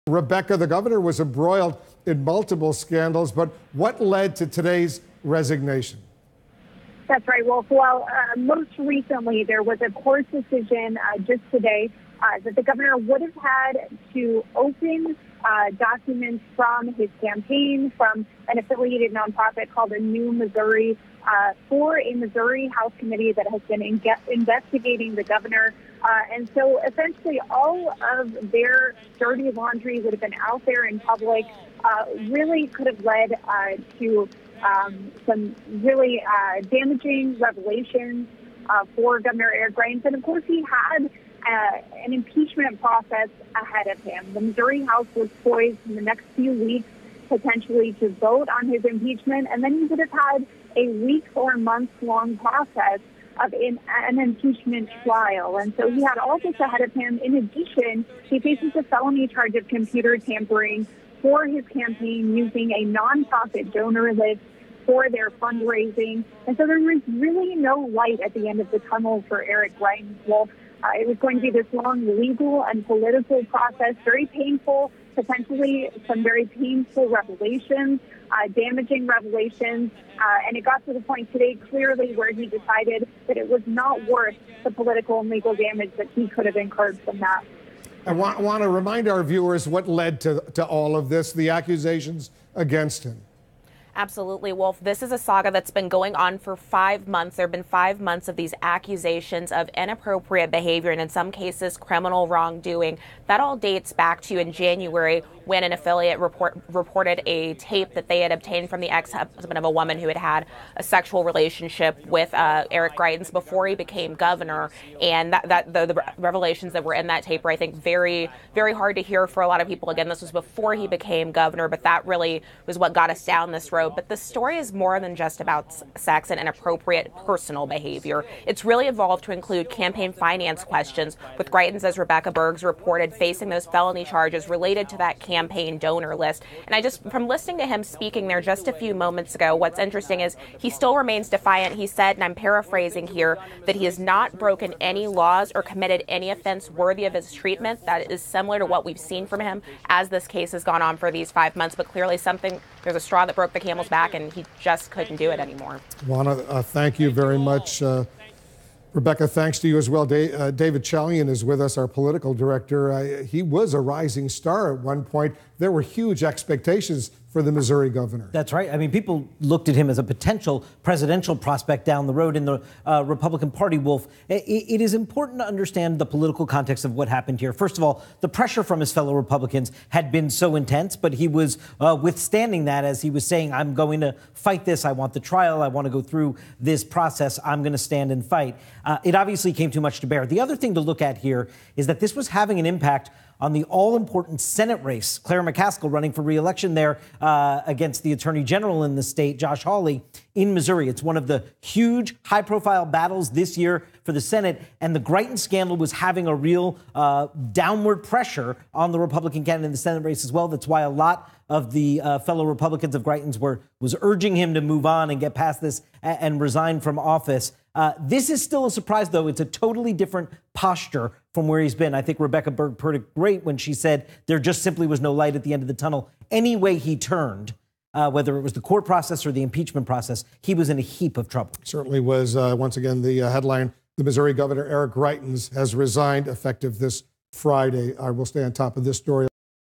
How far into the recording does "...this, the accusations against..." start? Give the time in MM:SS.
01:31.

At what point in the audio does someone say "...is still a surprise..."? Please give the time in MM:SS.
03:38.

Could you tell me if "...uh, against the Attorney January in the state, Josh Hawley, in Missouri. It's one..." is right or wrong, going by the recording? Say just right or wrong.
wrong.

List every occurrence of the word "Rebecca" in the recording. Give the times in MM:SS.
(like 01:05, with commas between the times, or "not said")
00:00, 02:11, 02:38, 03:42.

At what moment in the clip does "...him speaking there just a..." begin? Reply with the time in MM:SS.
02:17.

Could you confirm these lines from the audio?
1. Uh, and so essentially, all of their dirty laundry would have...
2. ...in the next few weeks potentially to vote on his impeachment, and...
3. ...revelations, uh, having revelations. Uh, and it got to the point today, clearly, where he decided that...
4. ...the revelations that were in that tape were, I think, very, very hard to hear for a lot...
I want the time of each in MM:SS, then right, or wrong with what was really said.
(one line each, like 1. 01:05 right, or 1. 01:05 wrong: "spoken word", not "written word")
1. 00:26 right
2. 00:45 right
3. 01:17 wrong: "damaging", not "having"
4. 01:55 right.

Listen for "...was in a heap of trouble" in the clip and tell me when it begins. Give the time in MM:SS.
03:50.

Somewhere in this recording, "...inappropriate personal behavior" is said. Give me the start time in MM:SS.
02:06.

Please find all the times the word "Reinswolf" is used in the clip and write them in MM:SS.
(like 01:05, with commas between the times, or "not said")
01:09.